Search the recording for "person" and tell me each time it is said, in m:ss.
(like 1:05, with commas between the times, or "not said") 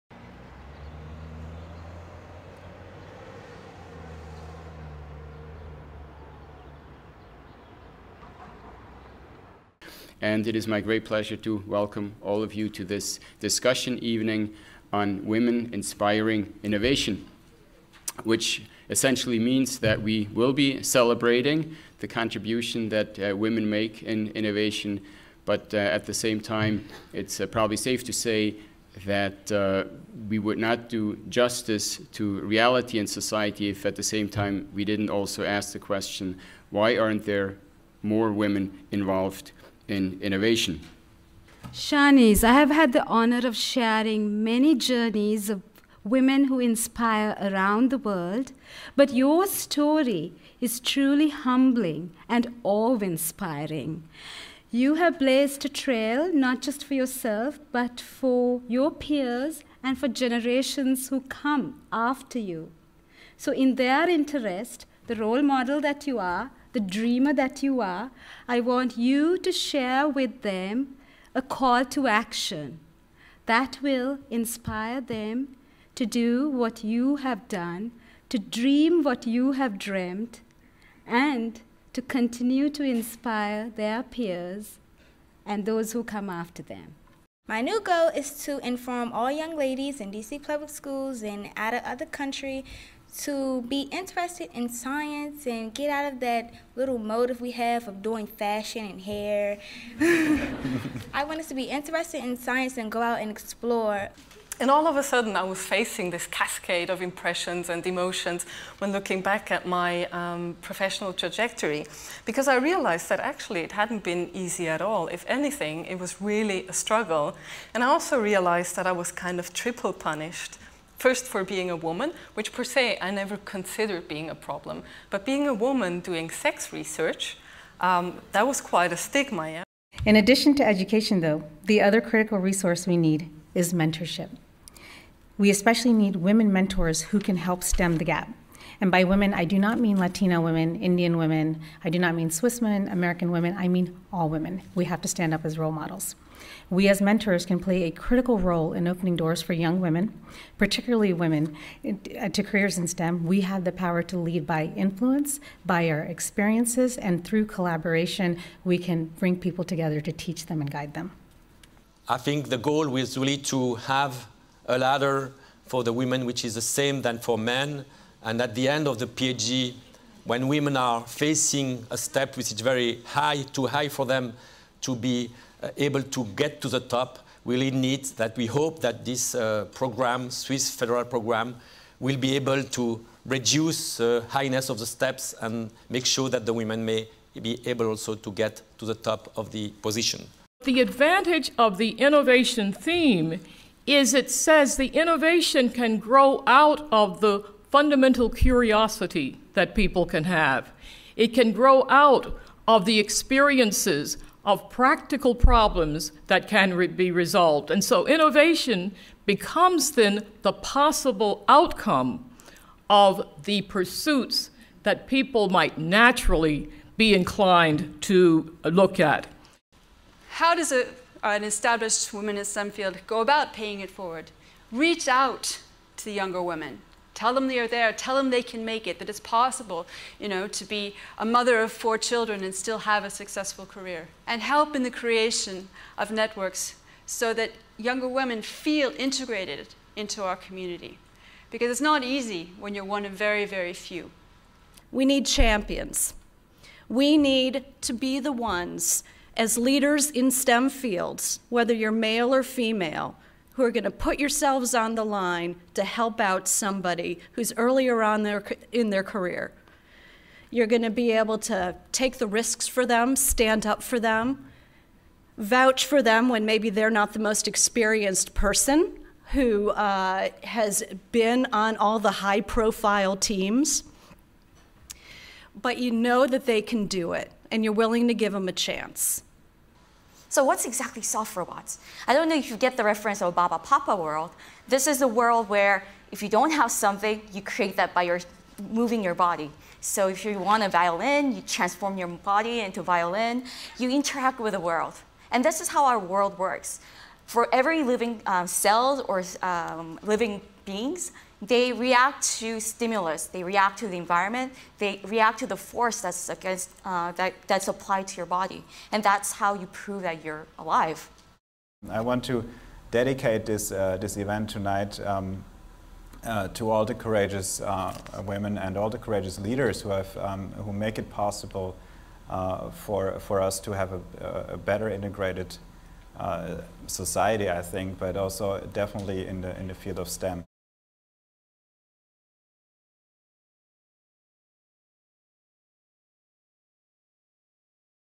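4:28.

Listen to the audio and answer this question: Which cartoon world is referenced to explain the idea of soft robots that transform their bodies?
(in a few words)
Barbapapa.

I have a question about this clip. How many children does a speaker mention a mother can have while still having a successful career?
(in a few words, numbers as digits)
4.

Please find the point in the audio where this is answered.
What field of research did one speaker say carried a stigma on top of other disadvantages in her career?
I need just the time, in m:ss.
2:06.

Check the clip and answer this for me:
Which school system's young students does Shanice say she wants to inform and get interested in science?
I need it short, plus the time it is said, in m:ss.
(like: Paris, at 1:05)
DC public schools, at 1:30.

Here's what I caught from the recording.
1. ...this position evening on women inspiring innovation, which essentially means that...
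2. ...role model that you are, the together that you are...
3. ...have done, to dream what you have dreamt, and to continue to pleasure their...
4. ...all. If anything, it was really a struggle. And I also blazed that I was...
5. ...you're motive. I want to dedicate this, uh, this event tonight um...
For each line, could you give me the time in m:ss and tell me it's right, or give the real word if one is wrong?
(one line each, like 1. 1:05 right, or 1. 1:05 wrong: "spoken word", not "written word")
1. 0:12 wrong: "discussion", not "position"
2. 1:05 wrong: "dreamer", not "together"
3. 1:17 wrong: "inspire", not "pleasure"
4. 1:54 wrong: "realized", not "blazed"
5. 5:10 wrong: "alive", not "motive".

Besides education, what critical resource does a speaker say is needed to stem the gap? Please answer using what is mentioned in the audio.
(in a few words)
Mentorship.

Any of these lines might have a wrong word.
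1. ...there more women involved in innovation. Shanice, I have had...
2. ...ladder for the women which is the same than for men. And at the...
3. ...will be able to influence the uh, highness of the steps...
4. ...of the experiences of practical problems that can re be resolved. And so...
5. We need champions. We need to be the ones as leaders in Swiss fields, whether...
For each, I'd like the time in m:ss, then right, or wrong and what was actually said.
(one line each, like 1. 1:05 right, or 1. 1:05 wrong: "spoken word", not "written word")
1. 0:37 right
2. 2:44 right
3. 3:01 wrong: "reduce", not "influence"
4. 3:22 right
5. 4:04 wrong: "STEM", not "Swiss".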